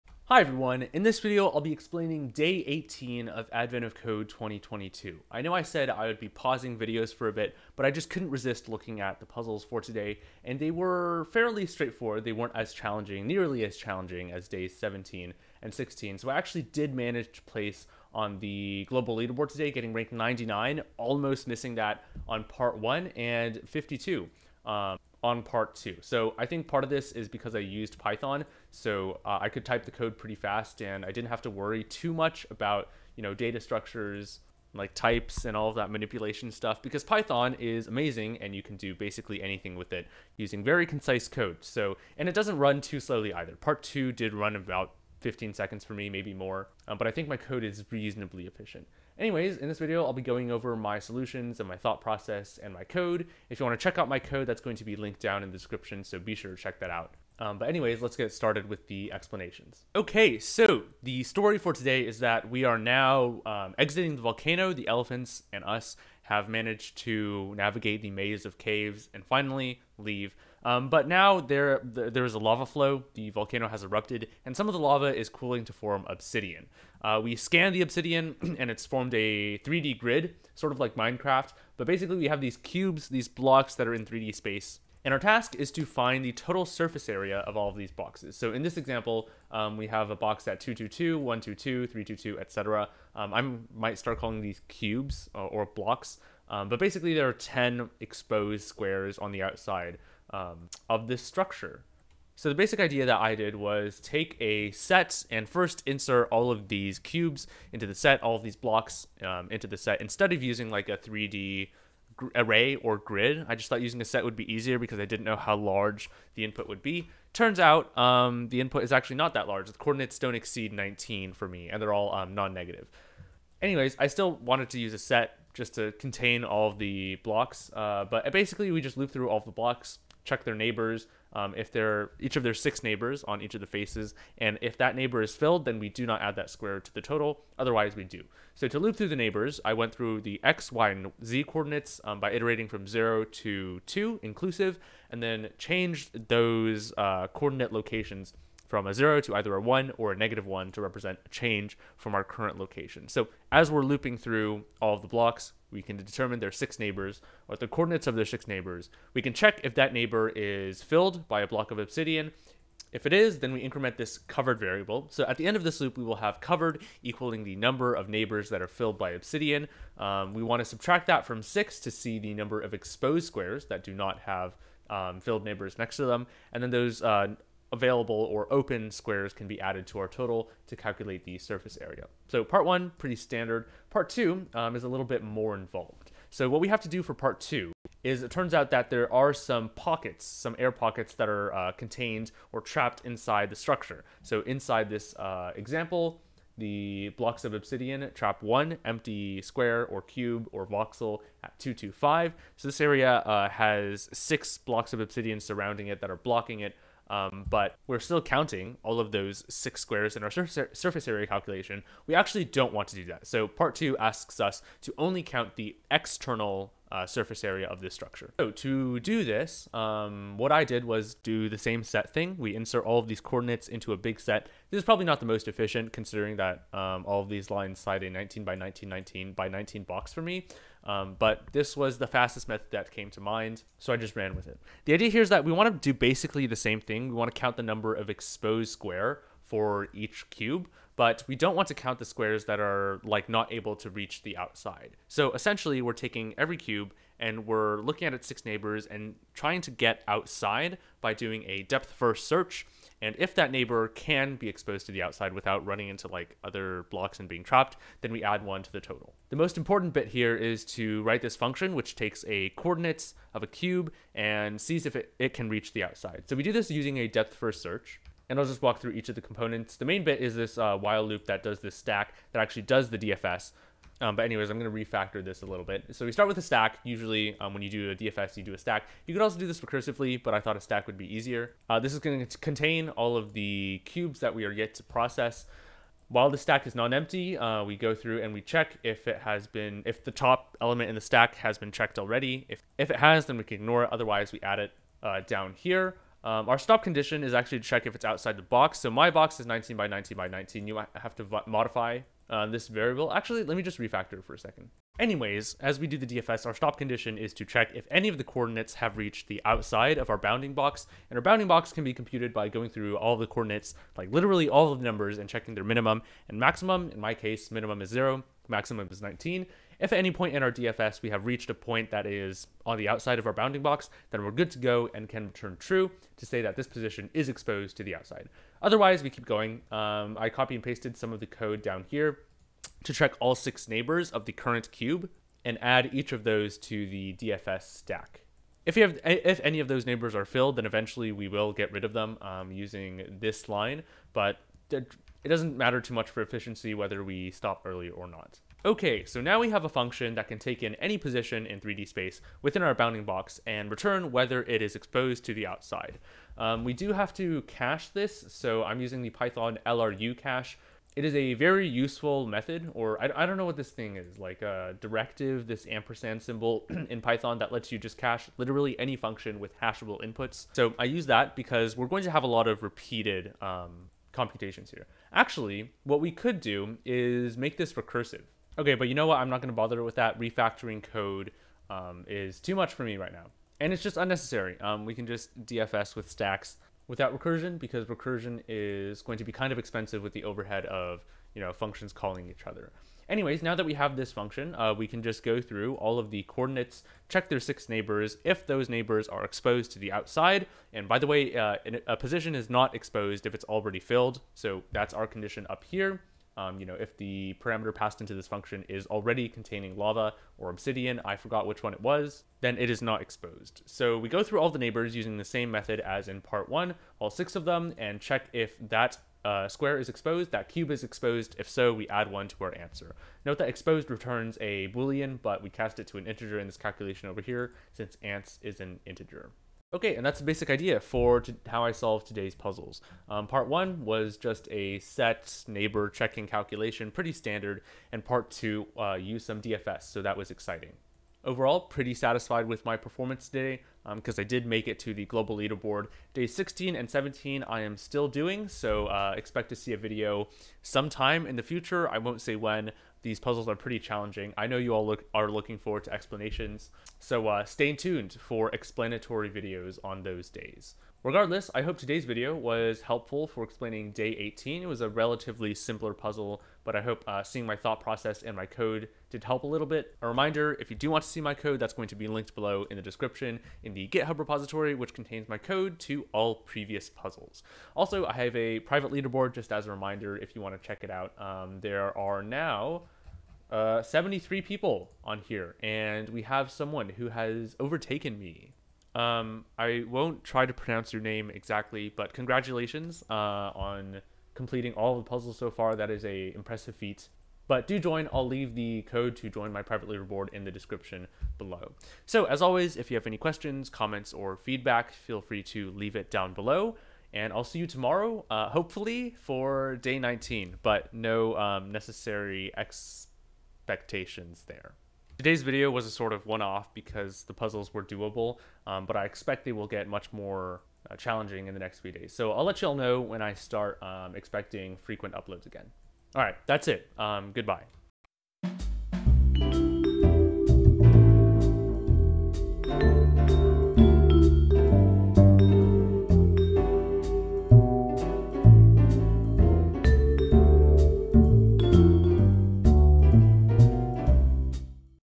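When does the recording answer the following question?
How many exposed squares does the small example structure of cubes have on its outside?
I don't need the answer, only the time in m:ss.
1:37.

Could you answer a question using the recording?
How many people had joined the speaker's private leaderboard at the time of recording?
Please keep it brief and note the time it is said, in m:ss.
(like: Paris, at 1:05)
73, at 8:03.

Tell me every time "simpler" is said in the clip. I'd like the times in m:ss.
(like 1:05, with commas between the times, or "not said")
7:45.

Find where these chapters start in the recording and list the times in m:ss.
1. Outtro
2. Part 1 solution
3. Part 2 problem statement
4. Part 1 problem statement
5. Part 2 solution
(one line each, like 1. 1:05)
1. 8:47
2. 1:42
3. 3:04
4. 0:59
5. 3:38.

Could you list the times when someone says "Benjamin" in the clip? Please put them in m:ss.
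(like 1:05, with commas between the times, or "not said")
not said.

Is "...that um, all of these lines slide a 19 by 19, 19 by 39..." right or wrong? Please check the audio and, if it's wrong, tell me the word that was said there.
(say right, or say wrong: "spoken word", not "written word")
wrong: "19", not "39".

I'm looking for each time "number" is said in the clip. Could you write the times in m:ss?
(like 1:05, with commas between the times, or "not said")
2:47, 2:52, 3:57, 5:14.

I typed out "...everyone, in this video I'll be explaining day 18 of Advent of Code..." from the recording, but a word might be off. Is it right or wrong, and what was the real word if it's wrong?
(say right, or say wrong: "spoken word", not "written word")
right.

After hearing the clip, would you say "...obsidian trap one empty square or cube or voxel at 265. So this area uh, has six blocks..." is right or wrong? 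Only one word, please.
wrong.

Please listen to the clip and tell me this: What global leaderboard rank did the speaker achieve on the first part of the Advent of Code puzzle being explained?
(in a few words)
99.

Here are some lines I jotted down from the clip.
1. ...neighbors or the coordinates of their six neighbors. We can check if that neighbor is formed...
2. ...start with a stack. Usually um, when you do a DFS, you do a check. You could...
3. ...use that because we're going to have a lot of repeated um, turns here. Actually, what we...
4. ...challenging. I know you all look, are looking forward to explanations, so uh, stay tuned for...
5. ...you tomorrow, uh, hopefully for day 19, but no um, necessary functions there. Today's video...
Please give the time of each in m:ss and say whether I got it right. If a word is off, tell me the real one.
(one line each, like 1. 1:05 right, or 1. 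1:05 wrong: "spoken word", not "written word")
1. 2:36 wrong: "filled", not "formed"
2. 4:36 wrong: "stack", not "check"
3. 6:10 wrong: "computations", not "turns"
4. 7:33 right
5. 8:27 wrong: "expectations", not "functions".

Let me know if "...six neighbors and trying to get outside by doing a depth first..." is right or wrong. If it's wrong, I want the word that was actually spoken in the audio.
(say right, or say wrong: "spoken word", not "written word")
right.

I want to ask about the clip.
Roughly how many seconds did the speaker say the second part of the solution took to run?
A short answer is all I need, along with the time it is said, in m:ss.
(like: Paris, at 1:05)
15 seconds, at 0:45.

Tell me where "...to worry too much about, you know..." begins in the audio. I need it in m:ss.
0:31.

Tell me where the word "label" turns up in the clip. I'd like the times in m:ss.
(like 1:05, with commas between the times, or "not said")
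not said.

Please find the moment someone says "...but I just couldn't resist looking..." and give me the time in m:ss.
0:07.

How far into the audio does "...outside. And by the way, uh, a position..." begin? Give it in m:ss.
6:39.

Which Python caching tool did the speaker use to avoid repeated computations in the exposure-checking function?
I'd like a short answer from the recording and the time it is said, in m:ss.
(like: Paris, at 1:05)
LRU cache, at 5:59.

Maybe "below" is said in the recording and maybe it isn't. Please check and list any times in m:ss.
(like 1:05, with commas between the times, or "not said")
7:52, 8:21, 8:26.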